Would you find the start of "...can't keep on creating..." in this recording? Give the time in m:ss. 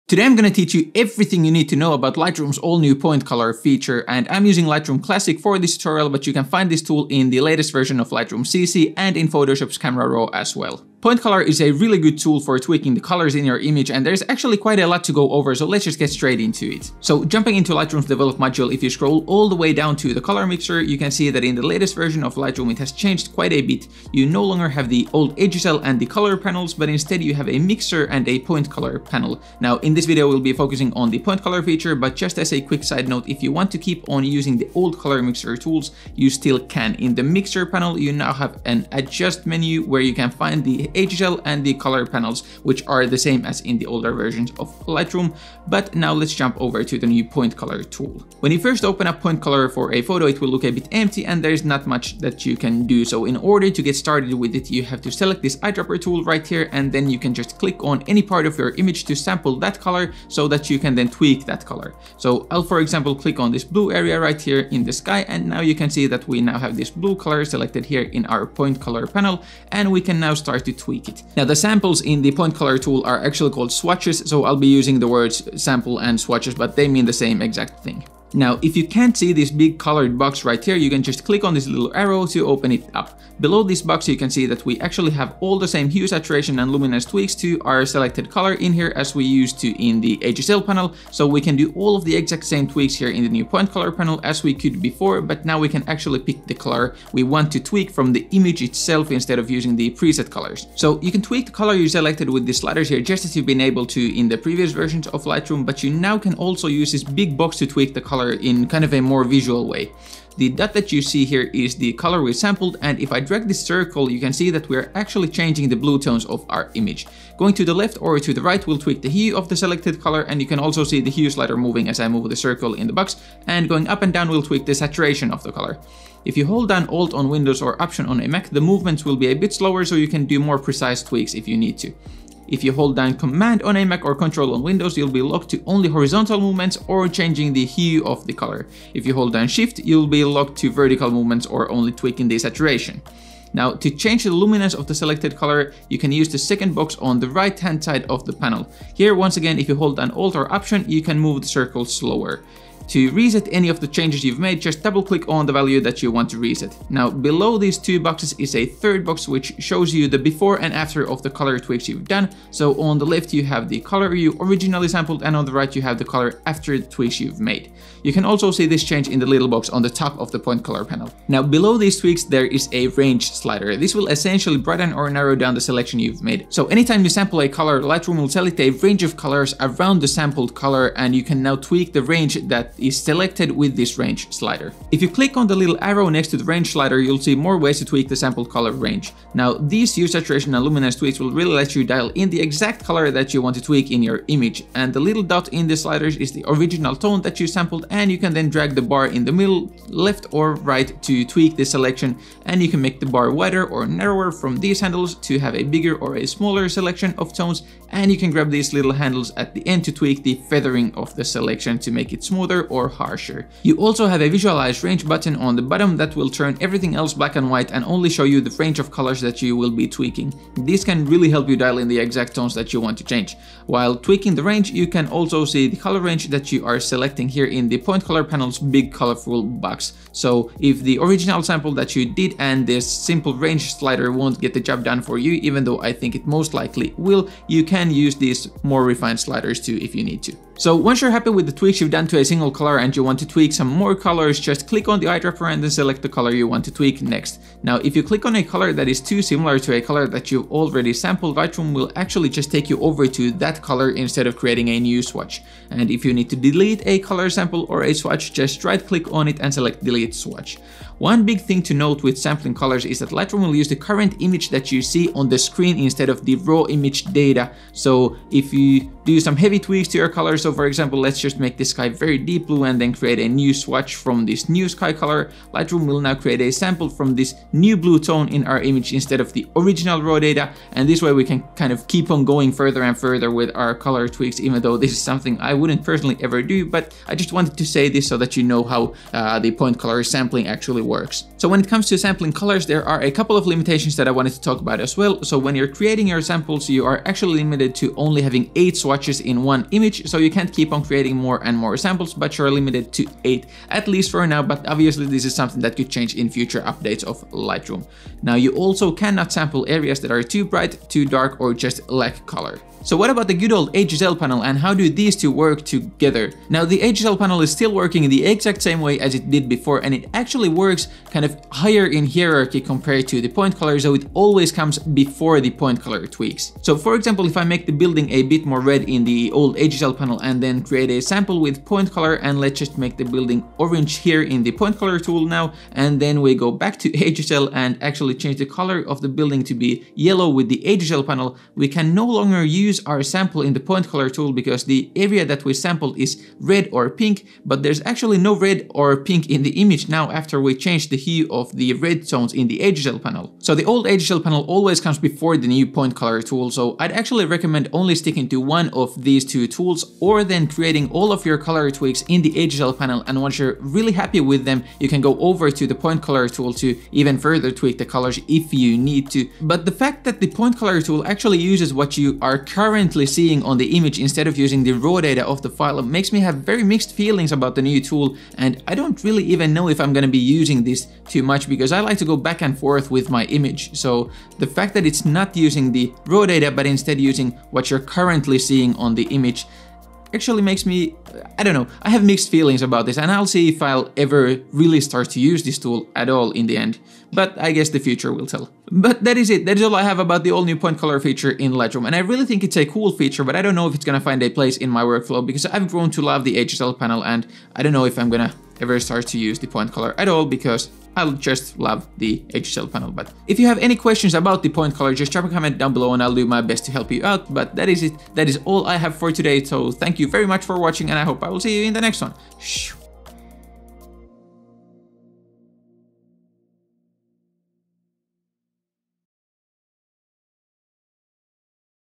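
5:00.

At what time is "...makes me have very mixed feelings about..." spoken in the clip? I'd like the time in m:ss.
6:15.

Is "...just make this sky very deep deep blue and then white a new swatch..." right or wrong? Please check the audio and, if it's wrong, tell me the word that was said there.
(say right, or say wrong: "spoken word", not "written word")
wrong: "create", not "white".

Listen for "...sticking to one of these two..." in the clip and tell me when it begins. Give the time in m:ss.
5:57.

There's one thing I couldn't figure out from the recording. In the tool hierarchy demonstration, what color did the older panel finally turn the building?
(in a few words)
yellow.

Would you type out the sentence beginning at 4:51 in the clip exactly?
So when it comes to sampling colors, there are a couple of limitations that I wanted to talk about as well.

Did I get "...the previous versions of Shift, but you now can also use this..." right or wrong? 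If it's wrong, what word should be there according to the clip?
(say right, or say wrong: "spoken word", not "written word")
wrong: "Lightroom", not "Shift".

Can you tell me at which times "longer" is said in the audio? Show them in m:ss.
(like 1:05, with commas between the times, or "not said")
0:24, 5:42.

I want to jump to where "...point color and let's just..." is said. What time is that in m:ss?
5:31.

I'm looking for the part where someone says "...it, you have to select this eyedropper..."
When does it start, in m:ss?
0:54.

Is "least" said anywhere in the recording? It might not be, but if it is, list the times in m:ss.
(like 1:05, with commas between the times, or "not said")
5:03.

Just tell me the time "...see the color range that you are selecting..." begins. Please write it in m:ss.
3:45.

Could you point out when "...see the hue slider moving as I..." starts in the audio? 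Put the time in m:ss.
2:00.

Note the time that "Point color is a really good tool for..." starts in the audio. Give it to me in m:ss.
0:11.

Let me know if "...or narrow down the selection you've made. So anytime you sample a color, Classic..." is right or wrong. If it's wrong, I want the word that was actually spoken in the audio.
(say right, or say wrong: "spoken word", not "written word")
wrong: "Lightroom", not "Classic".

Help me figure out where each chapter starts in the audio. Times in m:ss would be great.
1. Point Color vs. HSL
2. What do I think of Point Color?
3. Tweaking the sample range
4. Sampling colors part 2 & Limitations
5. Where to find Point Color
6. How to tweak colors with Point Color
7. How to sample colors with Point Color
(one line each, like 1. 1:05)
1. 5:13
2. 6:09
3. 2:51
4. 4:00
5. 0:17
6. 1:18
7. 0:48.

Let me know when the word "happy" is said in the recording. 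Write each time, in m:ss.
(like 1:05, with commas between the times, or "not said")
4:01, 6:03.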